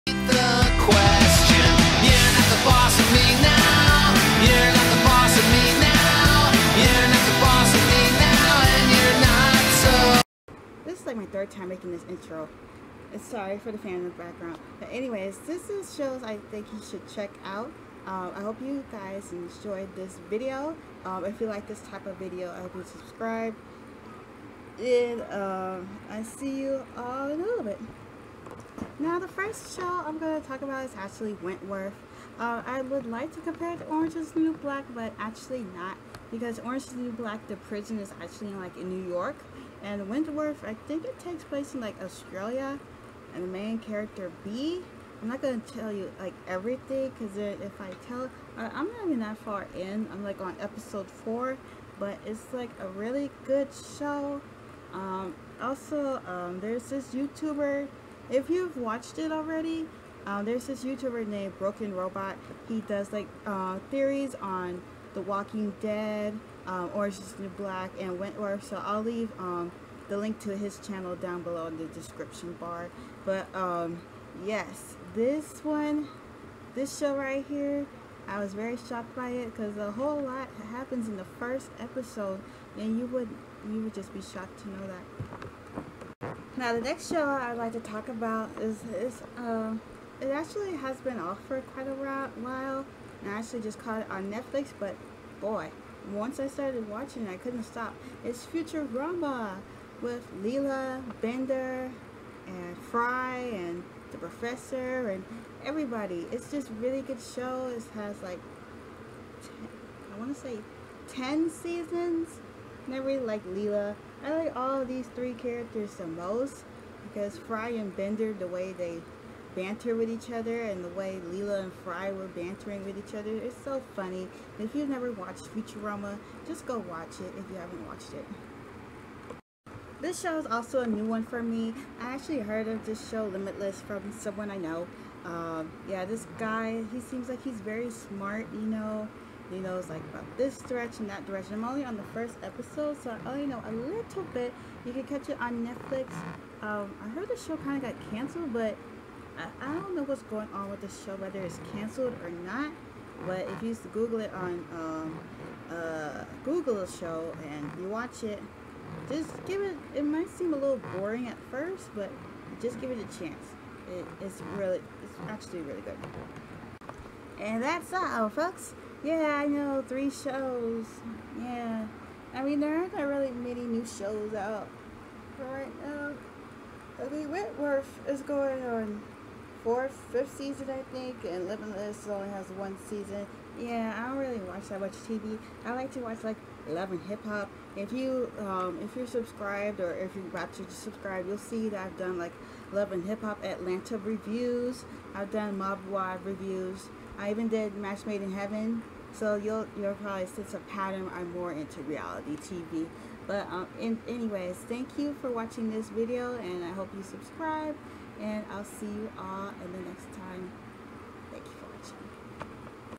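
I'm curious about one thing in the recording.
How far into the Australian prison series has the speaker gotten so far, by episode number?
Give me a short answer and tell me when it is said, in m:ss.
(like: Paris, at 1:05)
Episode 4, at 0:50.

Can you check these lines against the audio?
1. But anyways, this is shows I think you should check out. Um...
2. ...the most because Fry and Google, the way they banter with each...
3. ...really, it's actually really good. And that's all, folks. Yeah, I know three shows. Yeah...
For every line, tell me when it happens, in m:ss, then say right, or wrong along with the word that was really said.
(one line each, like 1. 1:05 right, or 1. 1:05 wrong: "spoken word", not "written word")
1. 0:14 right
2. 1:55 wrong: "Bender", not "Google"
3. 2:44 right.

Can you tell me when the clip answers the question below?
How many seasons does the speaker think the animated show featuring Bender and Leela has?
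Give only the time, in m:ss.
1:51.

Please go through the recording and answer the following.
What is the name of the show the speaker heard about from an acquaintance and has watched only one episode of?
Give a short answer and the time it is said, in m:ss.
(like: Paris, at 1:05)
Limitless, at 2:13.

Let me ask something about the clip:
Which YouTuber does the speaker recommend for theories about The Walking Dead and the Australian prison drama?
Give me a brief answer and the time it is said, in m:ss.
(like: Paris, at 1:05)
Broken Robot, at 1:01.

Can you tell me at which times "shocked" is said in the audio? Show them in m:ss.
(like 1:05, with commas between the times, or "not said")
1:18, 1:24.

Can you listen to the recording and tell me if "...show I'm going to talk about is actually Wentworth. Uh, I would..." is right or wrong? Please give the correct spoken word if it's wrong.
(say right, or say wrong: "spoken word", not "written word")
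right.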